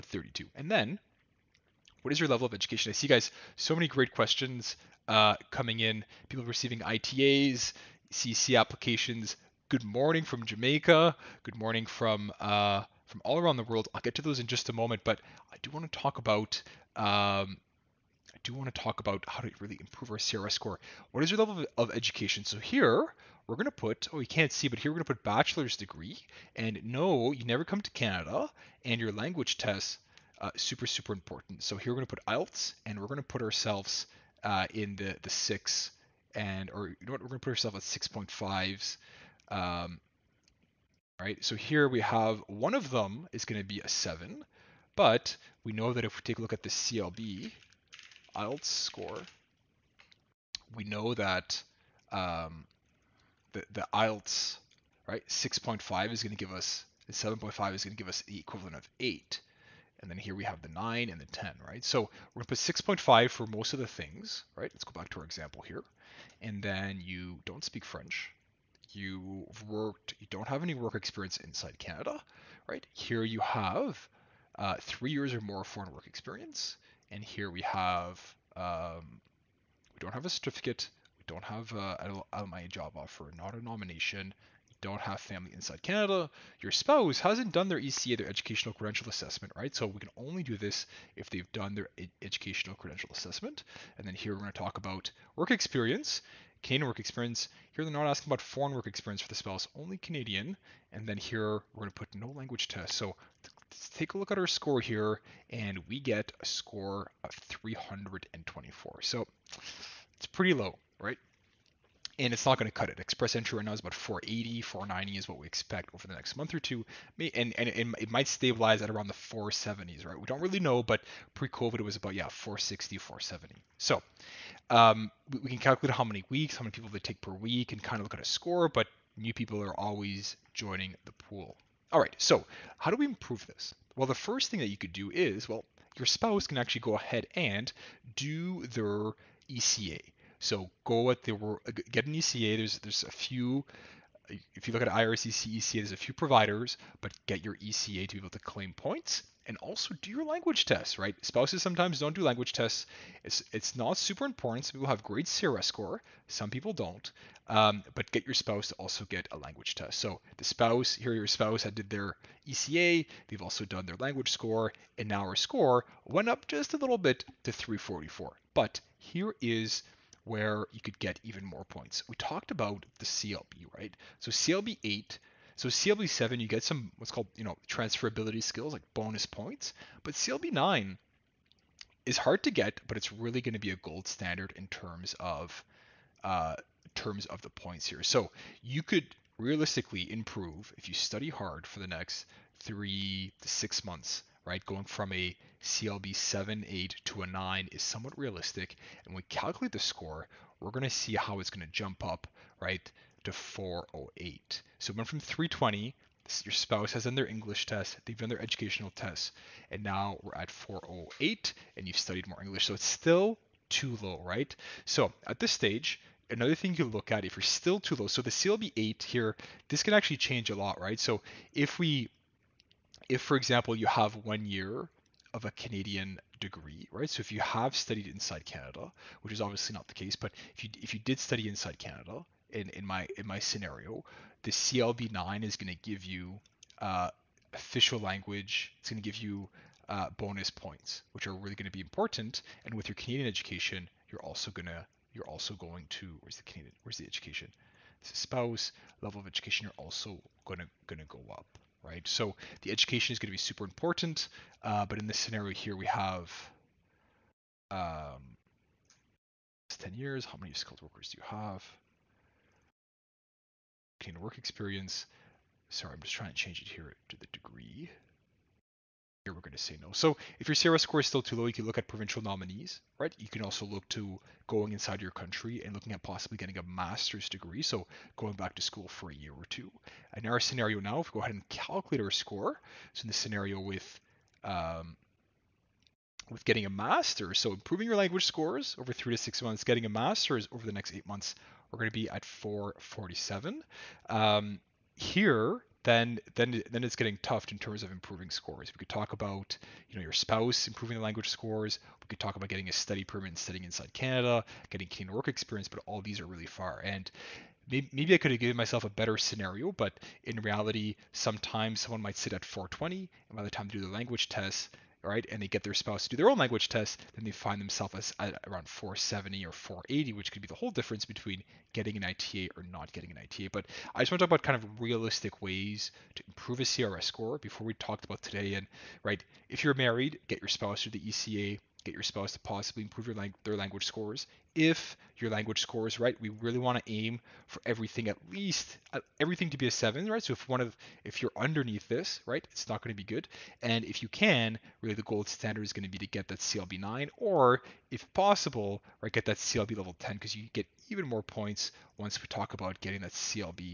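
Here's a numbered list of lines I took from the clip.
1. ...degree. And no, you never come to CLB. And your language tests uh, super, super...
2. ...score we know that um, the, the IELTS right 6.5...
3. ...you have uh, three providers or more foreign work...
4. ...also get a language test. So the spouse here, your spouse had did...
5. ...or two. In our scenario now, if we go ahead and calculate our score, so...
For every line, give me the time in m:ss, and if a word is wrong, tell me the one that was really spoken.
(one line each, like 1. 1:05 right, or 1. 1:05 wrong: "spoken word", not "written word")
1. 0:25 wrong: "Canada", not "CLB"
2. 0:48 right
3. 1:13 wrong: "years", not "providers"
4. 2:38 right
5. 4:39 right.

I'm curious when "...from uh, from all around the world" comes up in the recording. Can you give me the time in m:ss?
0:11.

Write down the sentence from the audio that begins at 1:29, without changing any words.
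So we can only do this if they've done their educational credential assessment.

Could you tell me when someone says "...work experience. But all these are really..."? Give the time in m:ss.
5:05.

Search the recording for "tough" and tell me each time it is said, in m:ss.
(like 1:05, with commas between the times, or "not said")
4:57.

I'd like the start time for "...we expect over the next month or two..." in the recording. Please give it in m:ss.
1:55.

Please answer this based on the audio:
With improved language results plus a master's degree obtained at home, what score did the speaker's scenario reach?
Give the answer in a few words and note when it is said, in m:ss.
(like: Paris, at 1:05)
447, at 4:52.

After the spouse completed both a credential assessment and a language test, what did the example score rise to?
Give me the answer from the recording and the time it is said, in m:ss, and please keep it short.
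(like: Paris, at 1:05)
344, at 2:47.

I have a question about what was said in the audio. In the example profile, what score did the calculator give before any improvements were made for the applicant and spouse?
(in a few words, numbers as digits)
324.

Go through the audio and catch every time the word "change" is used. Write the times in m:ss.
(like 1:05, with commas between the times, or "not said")
3:40, 4:26.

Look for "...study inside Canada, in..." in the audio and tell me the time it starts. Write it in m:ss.
3:51.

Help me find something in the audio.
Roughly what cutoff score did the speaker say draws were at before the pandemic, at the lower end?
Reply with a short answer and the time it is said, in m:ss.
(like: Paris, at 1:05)
460, at 2:02.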